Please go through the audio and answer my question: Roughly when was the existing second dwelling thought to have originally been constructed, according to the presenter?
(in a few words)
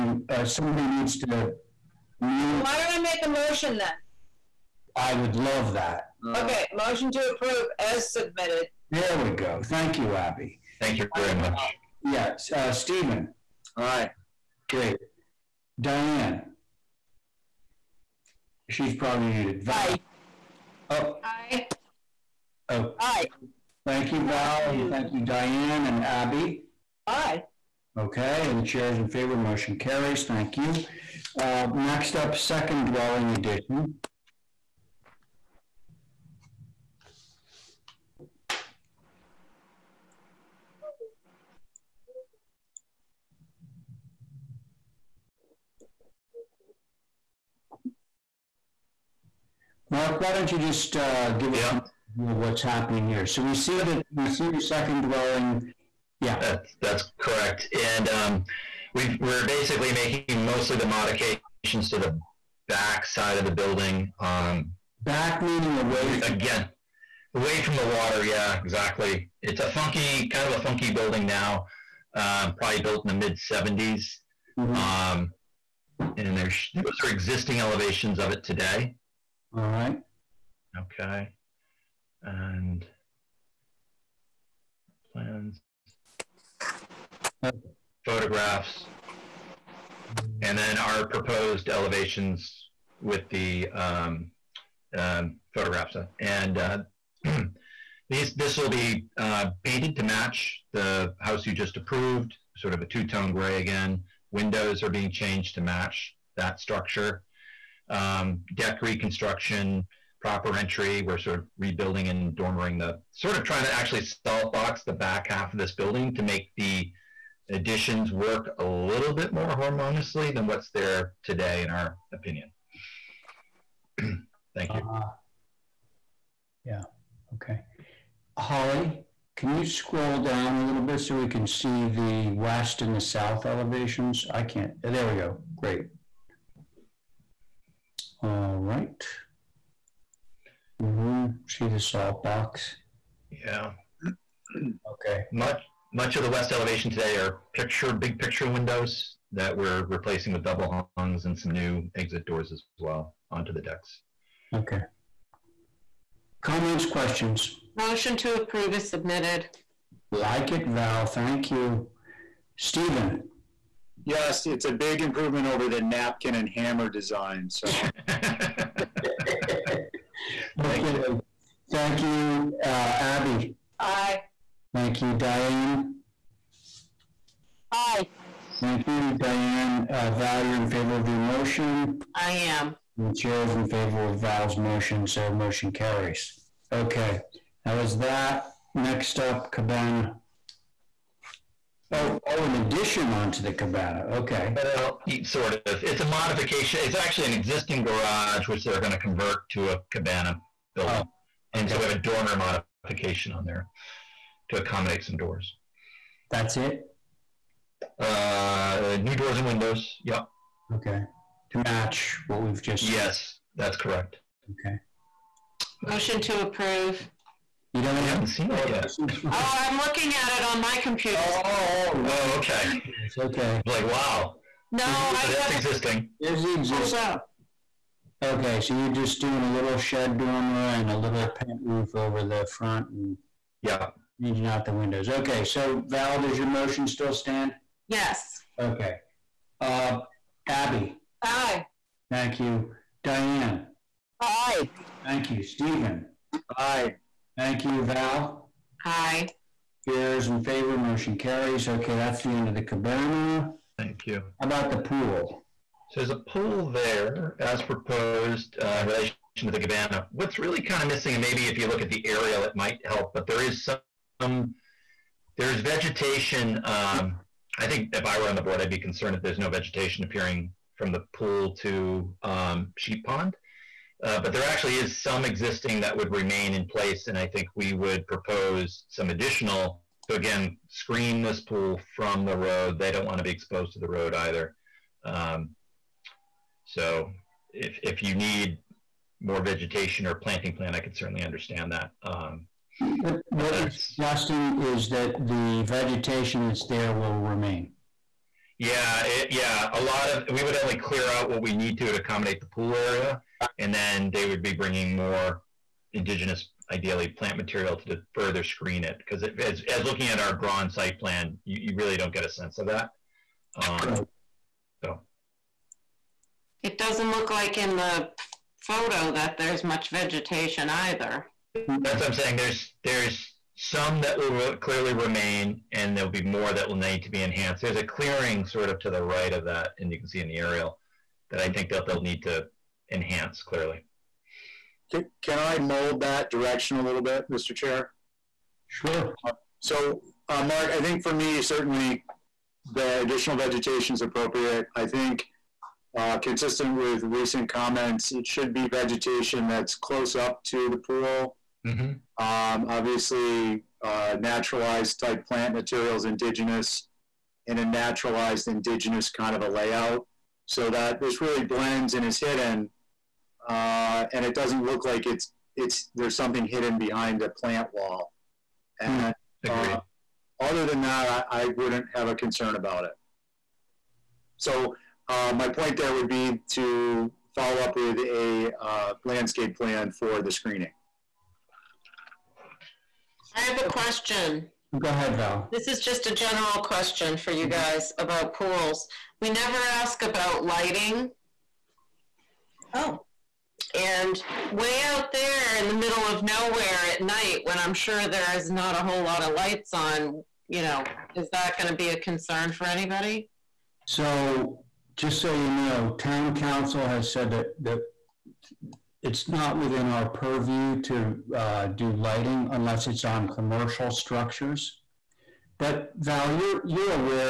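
mid 70s.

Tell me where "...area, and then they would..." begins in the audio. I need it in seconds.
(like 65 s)
302 s.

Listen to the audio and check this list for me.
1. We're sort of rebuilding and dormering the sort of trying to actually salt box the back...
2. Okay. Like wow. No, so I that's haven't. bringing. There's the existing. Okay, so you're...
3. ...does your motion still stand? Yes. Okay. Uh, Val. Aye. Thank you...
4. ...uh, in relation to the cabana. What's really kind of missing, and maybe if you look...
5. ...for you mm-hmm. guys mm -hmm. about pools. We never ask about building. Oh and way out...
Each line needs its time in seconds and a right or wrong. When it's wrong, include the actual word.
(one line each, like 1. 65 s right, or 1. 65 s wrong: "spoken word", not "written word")
1. 111 s right
2. 223 s wrong: "existing", not "bringing"
3. 236 s wrong: "Abby", not "Val"
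4. 258 s right
5. 387 s wrong: "lighting", not "building".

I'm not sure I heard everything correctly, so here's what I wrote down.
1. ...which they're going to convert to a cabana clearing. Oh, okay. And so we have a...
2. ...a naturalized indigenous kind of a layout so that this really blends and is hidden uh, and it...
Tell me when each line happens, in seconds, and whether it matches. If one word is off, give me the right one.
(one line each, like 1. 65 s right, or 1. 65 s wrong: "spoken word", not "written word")
1. 198 s wrong: "building", not "clearing"
2. 357 s right.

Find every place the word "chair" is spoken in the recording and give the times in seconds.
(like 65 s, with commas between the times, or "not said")
28 s, 183 s, 249 s, 337 s.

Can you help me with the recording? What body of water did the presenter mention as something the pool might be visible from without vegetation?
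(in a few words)
Sheep Pond.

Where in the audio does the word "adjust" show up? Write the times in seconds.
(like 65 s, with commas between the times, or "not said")
not said.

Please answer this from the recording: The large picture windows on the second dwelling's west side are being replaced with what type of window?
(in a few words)
double hungs.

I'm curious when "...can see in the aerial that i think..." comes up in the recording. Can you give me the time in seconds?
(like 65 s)
329 s.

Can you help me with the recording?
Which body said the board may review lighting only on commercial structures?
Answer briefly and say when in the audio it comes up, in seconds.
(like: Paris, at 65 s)
town council, at 405 s.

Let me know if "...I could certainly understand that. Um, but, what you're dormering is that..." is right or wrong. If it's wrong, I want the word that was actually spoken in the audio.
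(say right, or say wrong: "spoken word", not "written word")
wrong: "suggesting", not "dormering".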